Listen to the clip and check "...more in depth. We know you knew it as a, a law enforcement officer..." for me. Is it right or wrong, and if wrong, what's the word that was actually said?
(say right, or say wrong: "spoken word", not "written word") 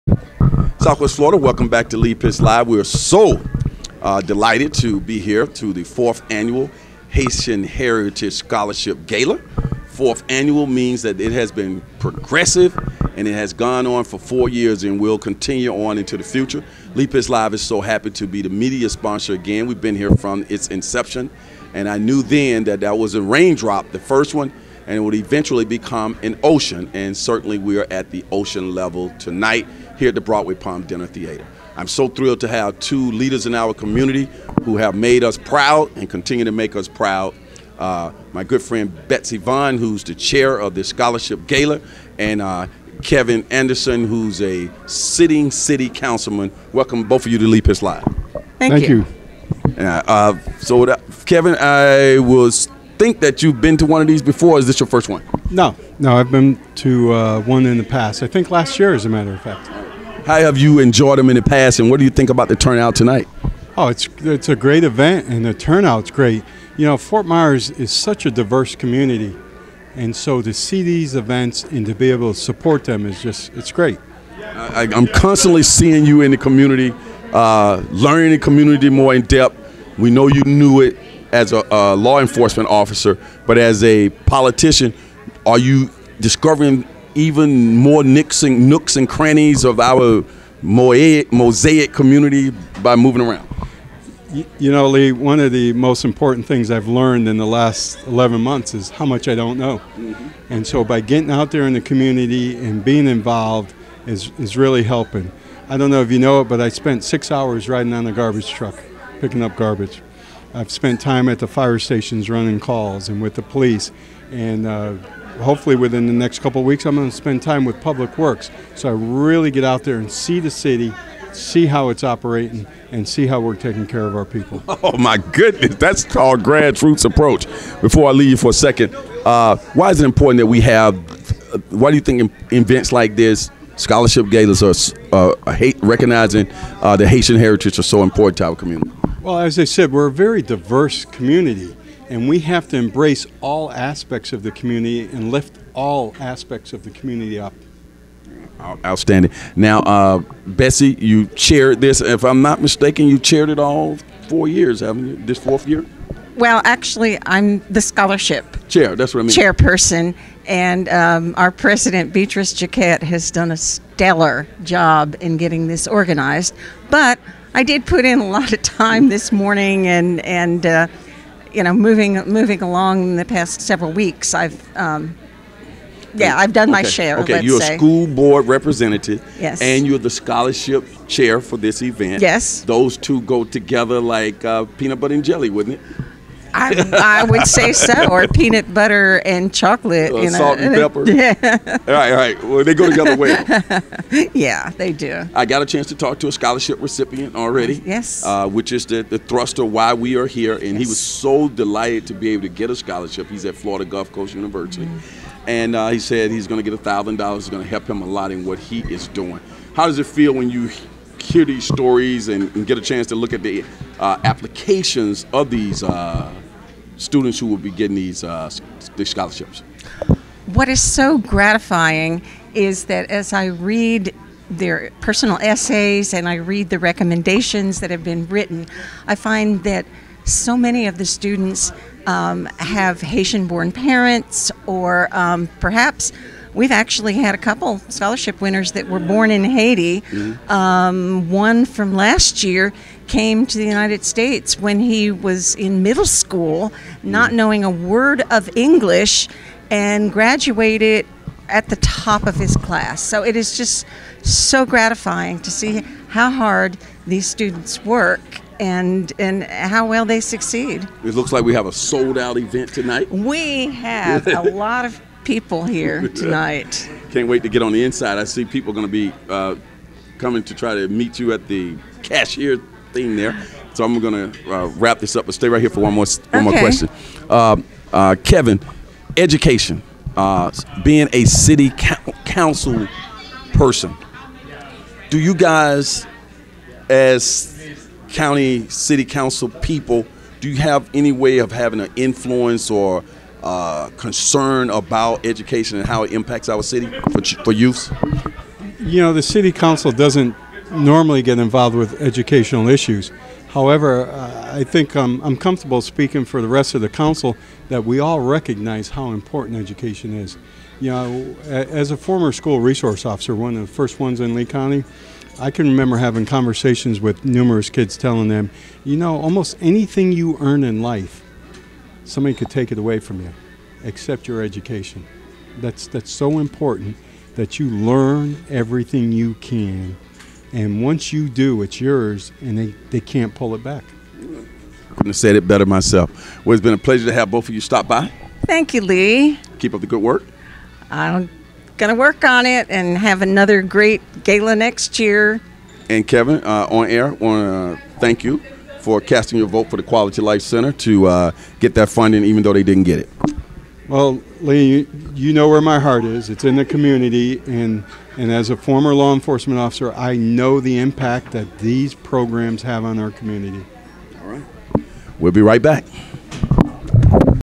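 right.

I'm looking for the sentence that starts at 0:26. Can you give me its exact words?
And certainly we are at the ocean level tonight here at the Broadway Palm Dinner Theater.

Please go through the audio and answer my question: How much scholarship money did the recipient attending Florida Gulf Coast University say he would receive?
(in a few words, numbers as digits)
$1,000.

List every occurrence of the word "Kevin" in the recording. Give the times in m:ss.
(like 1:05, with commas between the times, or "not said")
0:43, 0:51, 4:38, 5:46.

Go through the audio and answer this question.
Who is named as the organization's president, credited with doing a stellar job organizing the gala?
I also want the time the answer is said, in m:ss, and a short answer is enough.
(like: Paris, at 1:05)
Beatrice Jaquette, at 2:42.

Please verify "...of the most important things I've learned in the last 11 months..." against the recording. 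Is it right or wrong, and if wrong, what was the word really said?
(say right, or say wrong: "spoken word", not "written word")
right.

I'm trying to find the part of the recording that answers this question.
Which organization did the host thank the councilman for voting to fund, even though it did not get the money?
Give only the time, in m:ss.
5:49.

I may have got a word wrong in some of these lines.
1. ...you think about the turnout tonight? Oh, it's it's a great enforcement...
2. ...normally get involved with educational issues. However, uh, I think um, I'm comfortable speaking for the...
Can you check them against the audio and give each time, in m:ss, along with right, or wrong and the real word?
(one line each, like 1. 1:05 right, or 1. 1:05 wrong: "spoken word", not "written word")
1. 1:02 wrong: "event", not "enforcement"
2. 5:00 right.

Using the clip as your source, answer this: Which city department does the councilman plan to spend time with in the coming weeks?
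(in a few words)
Public Works.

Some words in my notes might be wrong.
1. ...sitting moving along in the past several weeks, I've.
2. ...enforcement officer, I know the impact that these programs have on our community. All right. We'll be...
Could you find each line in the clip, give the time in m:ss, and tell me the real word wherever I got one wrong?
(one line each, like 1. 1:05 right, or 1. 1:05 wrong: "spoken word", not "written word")
1. 2:51 wrong: "moving", not "sitting"
2. 5:59 right.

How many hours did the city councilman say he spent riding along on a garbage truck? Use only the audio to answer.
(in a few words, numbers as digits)
6.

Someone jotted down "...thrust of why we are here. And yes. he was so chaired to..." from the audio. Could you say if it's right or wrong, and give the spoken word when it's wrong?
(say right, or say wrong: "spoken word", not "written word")
wrong: "delighted", not "chaired".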